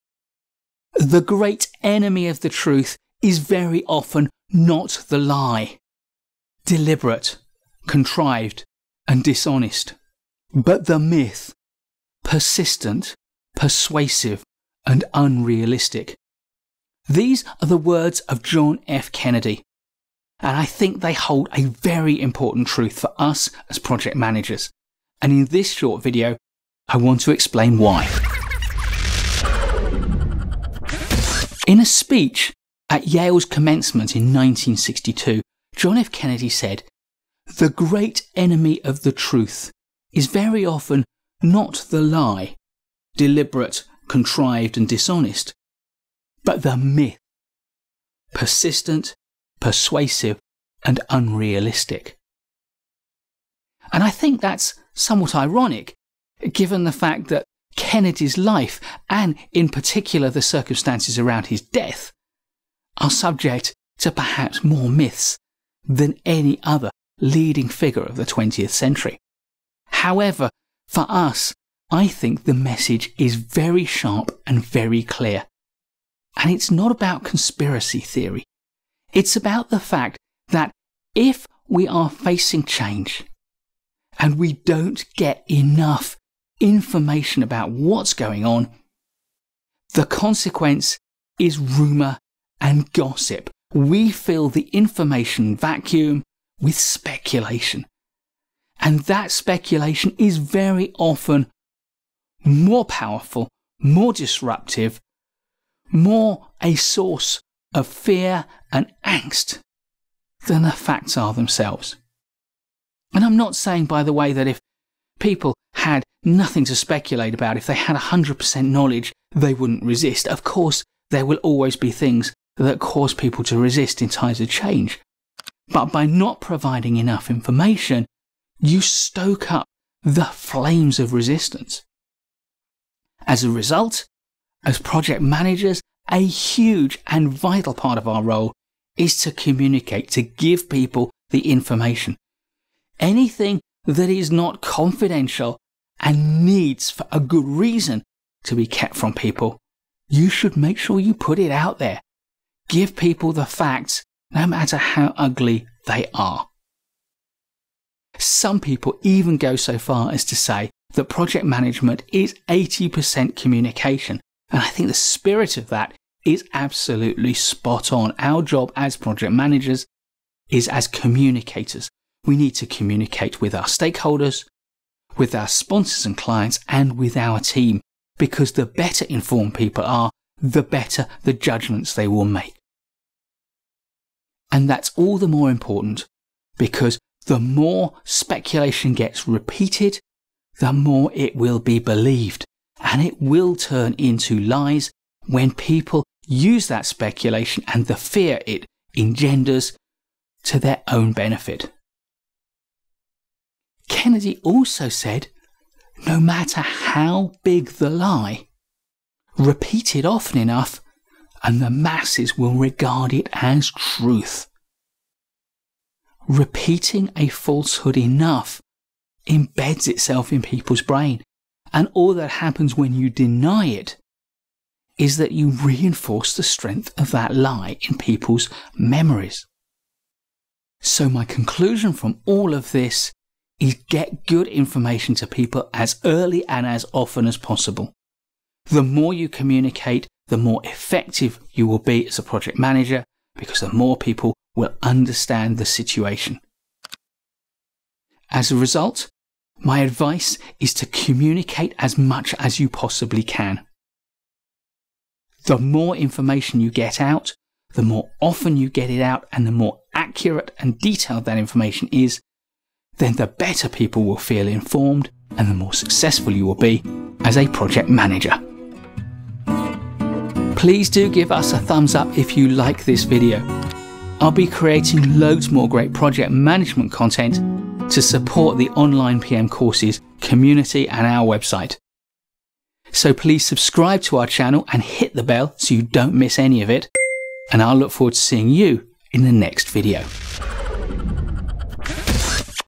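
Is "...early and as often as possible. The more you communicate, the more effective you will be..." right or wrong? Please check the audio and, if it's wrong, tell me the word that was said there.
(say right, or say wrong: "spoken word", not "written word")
right.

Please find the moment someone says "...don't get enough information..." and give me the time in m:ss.
1:24.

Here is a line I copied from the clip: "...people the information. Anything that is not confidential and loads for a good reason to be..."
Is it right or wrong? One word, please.
wrong.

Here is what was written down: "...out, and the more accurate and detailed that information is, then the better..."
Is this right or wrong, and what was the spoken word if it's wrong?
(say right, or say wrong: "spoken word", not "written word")
right.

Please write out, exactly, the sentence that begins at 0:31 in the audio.
In a speech at Yale's commencement in 1962, John F.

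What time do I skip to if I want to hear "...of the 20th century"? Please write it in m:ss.
1:08.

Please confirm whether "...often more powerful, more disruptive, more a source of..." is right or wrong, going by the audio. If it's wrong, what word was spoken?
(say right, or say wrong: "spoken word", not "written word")
right.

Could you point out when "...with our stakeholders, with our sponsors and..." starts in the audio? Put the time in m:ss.
2:53.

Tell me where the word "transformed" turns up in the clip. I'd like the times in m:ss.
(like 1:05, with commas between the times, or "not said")
not said.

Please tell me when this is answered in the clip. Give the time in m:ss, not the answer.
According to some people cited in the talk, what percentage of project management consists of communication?
2:42.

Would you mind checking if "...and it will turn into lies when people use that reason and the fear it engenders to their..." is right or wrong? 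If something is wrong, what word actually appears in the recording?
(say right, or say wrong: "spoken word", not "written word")
wrong: "speculation", not "reason".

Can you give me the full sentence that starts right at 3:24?
Kennedy also said, no matter how big the lie, repeat it often enough, and the masses will regard it as truth.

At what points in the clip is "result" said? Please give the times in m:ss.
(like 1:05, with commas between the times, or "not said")
2:13, 4:08.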